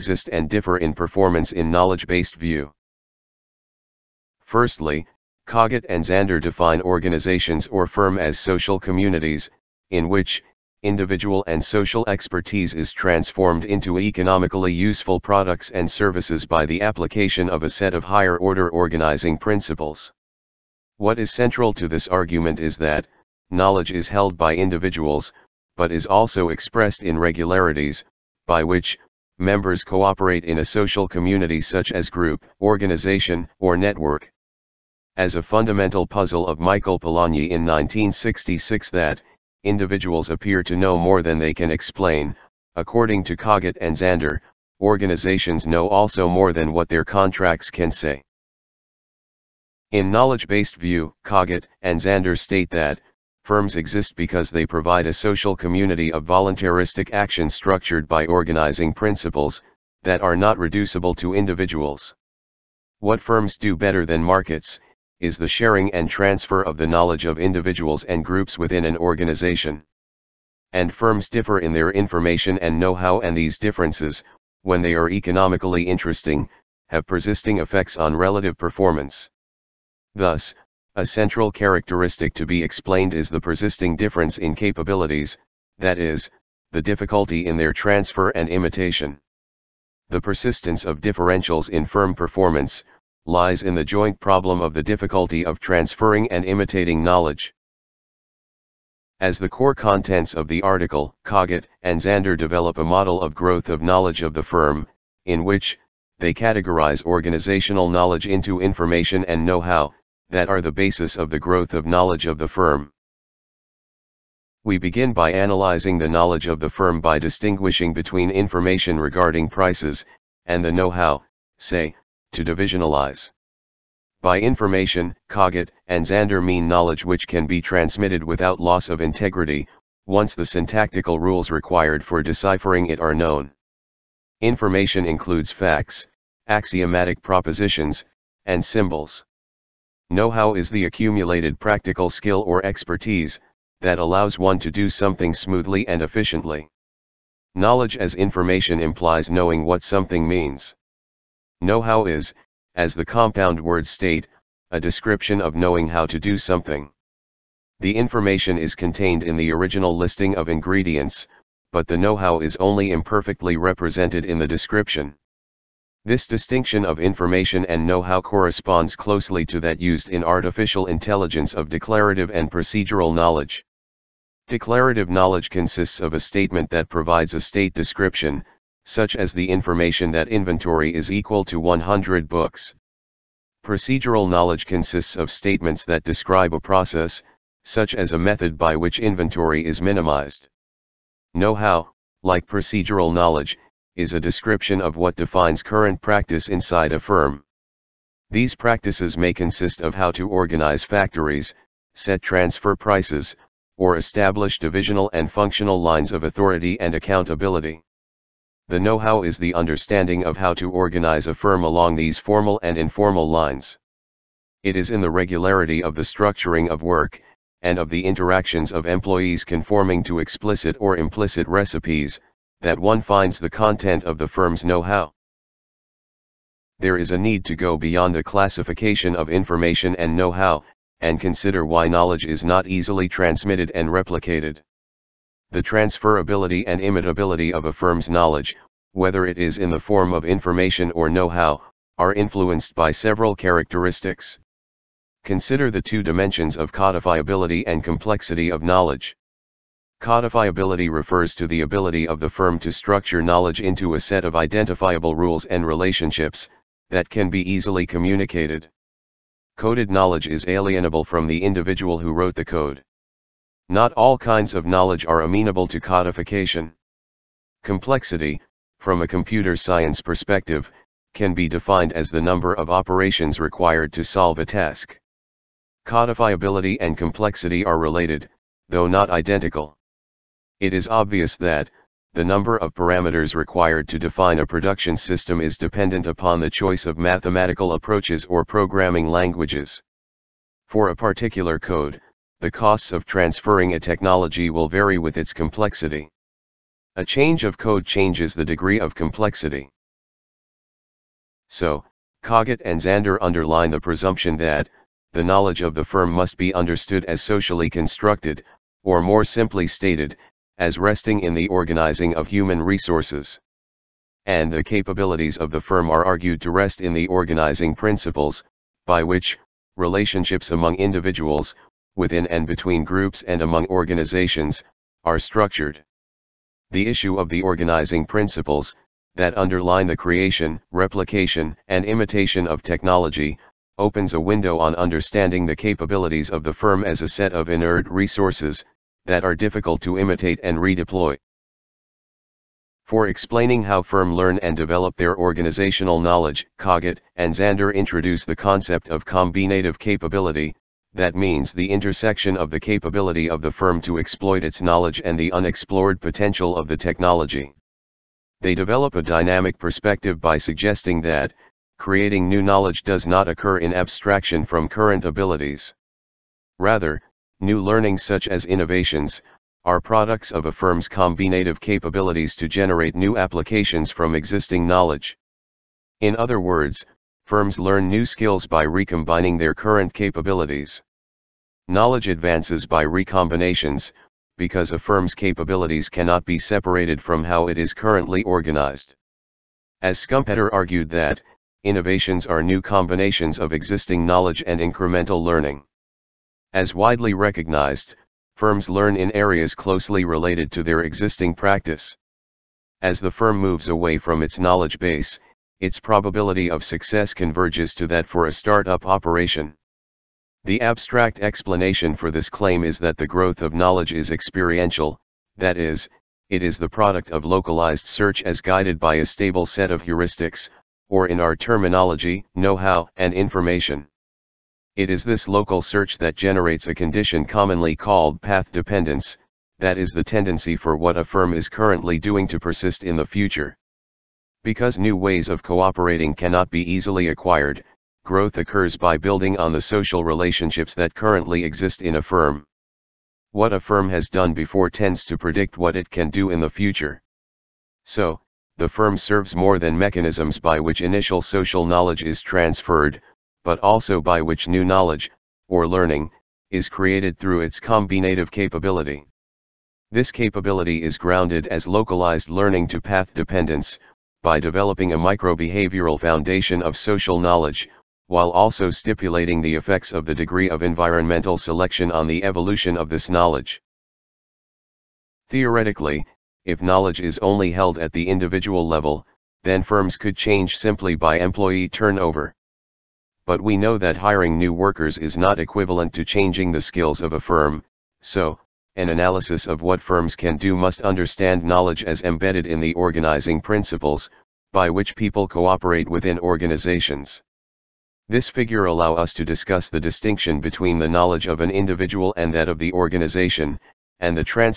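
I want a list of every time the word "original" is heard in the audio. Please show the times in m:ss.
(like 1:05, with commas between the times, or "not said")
2:39.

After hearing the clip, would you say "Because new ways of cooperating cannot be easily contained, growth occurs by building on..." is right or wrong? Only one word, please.
wrong.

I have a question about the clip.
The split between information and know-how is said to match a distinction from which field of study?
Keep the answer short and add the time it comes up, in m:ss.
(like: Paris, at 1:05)
artificial intelligence, at 2:50.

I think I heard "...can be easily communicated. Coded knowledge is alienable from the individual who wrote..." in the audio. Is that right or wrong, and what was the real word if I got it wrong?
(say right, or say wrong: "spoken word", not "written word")
right.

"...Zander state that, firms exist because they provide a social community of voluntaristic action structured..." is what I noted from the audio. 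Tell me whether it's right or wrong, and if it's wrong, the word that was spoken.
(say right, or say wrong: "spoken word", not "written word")
right.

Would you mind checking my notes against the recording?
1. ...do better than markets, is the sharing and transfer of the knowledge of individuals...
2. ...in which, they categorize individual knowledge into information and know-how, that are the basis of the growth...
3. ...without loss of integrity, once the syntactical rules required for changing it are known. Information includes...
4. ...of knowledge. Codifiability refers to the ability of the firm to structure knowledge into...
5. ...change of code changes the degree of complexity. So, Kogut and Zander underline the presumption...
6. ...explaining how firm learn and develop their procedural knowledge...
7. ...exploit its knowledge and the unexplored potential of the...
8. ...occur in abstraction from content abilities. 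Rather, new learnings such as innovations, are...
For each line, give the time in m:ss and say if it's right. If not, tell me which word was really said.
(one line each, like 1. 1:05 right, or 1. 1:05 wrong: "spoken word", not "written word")
1. 1:03 right
2. 1:45 wrong: "organizational", not "individual"
3. 2:08 wrong: "deciphering", not "changing"
4. 4:08 right
5. 4:57 right
6. 5:43 wrong: "organizational", not "procedural"
7. 5:53 right
8. 6:03 wrong: "current", not "content".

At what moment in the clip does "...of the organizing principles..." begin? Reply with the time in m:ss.
5:27.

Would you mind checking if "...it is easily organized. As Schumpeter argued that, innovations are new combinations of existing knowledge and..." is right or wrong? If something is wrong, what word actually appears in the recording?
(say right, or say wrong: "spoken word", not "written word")
wrong: "currently", not "easily".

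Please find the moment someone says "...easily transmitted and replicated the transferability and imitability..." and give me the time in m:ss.
3:52.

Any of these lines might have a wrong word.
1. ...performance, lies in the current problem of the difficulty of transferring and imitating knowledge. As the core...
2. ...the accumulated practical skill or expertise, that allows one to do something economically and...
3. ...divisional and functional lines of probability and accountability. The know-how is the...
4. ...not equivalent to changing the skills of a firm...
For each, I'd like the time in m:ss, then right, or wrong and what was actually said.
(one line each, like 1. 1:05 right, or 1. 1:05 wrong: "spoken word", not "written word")
1. 1:32 wrong: "joint", not "current"
2. 2:20 wrong: "smoothly", not "economically"
3. 3:24 wrong: "authority", not "probability"
4. 8:05 right.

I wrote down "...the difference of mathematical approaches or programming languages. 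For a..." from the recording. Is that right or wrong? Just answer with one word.
wrong.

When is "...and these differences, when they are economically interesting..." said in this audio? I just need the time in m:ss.
1:13.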